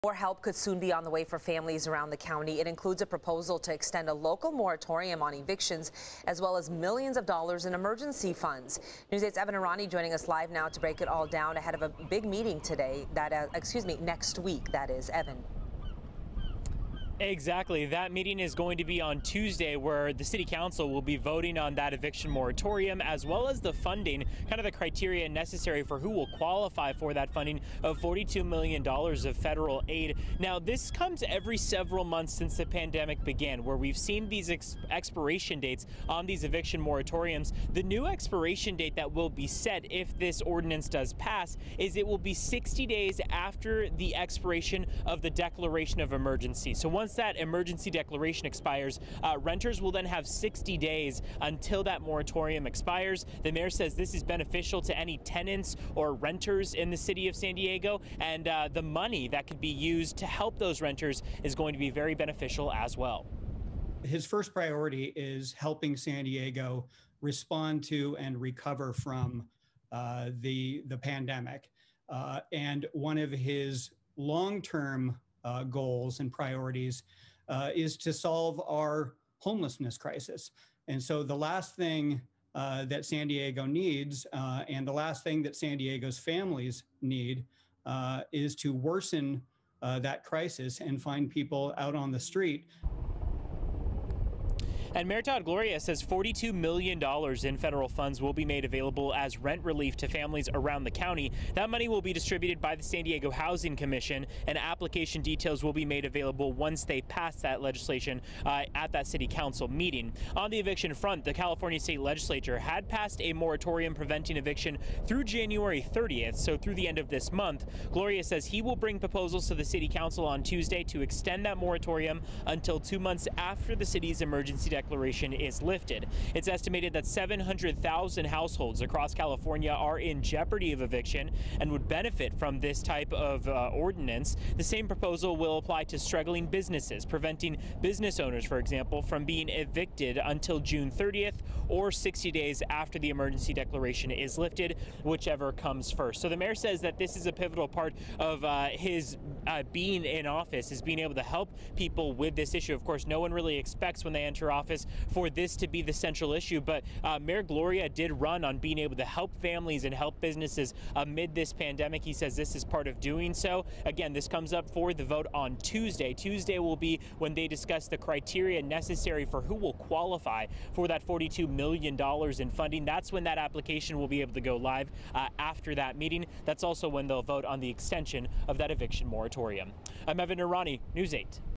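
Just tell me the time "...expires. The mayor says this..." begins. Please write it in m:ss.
0:52.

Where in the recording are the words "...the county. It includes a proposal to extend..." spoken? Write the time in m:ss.
0:02.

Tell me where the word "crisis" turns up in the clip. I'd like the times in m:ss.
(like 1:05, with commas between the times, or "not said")
1:19, 1:30.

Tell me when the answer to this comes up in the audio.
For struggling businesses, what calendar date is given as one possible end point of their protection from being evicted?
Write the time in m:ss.
2:20.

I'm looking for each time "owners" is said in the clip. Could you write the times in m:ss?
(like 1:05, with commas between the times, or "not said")
2:18.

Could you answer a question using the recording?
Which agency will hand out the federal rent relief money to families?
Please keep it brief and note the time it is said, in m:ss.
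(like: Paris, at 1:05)
San Diego Housing Commission, at 1:42.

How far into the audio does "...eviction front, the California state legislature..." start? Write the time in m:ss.
1:50.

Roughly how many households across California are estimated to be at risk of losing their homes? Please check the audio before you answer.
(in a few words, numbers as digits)
700,000.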